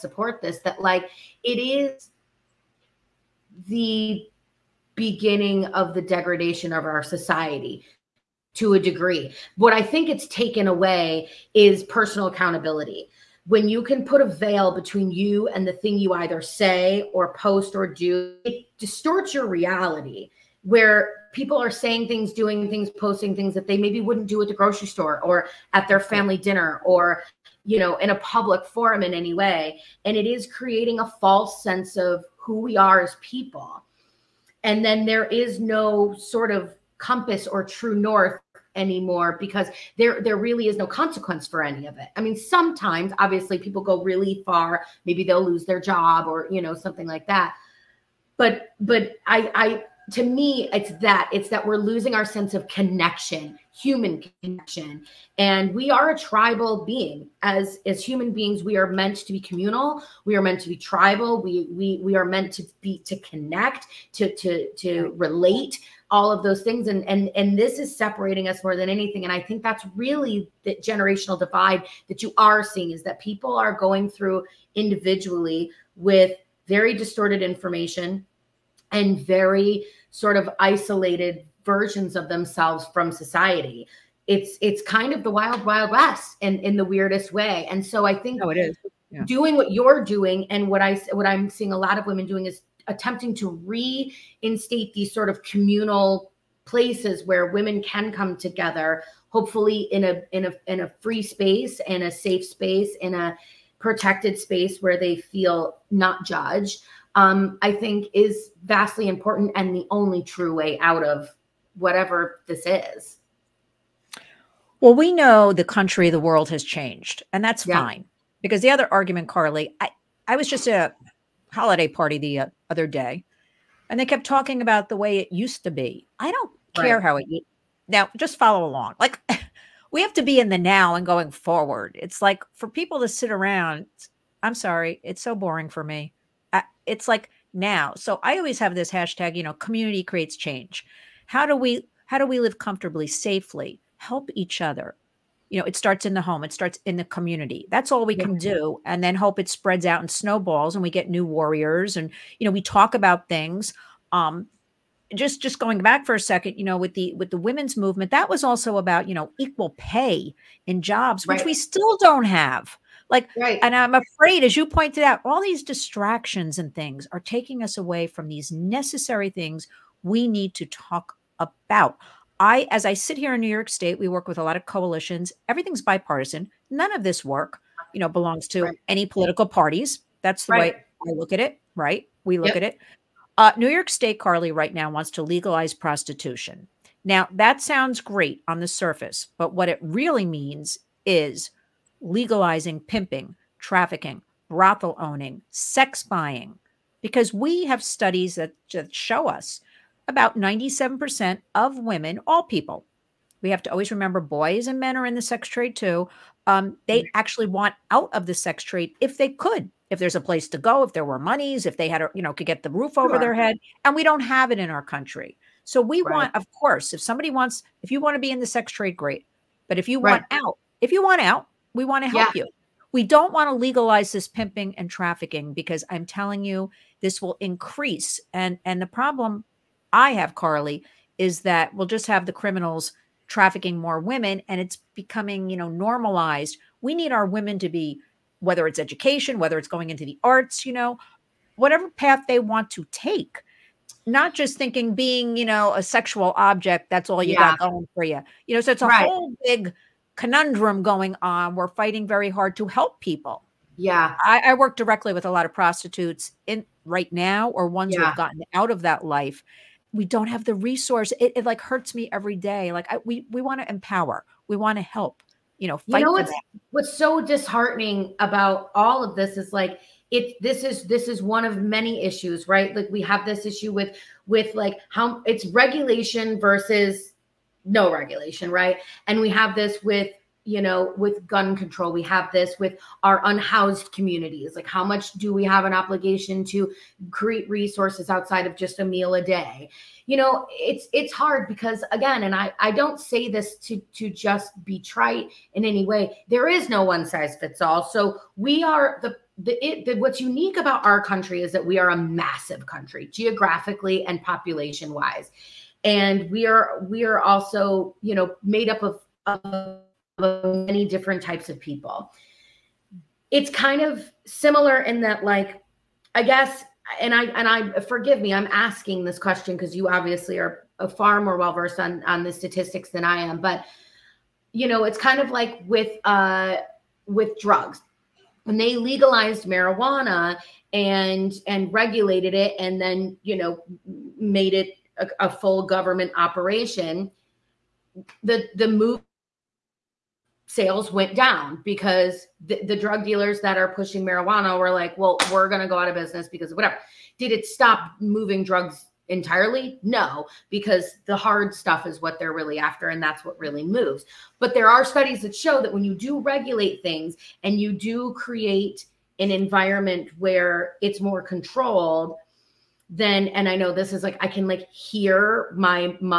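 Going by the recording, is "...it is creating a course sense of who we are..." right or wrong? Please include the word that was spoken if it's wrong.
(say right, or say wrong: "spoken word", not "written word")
wrong: "false", not "course".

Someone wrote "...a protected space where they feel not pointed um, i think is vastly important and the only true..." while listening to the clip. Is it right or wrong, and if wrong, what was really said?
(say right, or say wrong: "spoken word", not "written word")
wrong: "judged", not "pointed".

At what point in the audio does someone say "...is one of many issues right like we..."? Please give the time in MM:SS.
04:31.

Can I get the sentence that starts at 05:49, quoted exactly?
No, because the hard stuff is what they're really after and that's what really moves.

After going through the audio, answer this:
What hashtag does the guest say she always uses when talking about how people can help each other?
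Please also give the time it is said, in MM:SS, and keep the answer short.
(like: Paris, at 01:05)
community creates change, at 02:19.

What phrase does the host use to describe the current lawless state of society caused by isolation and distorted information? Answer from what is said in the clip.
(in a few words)
wild wild west.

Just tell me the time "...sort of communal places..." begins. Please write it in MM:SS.
01:35.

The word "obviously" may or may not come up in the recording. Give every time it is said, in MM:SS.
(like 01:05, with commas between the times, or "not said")
00:43, 05:19.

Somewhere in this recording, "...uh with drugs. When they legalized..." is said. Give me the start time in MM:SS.
05:26.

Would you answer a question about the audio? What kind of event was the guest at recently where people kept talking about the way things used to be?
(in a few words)
holiday party.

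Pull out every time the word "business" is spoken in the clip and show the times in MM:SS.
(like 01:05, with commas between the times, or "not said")
05:45.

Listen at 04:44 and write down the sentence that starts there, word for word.
Like, how much do we have an obligation to create resources outside of just a meal a day?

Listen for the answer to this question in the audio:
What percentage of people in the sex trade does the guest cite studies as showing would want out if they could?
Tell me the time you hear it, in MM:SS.
03:20.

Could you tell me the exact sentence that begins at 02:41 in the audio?
we still don't have like right.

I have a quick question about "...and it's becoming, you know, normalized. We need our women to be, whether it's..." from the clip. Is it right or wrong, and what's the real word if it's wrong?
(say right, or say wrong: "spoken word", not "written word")
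right.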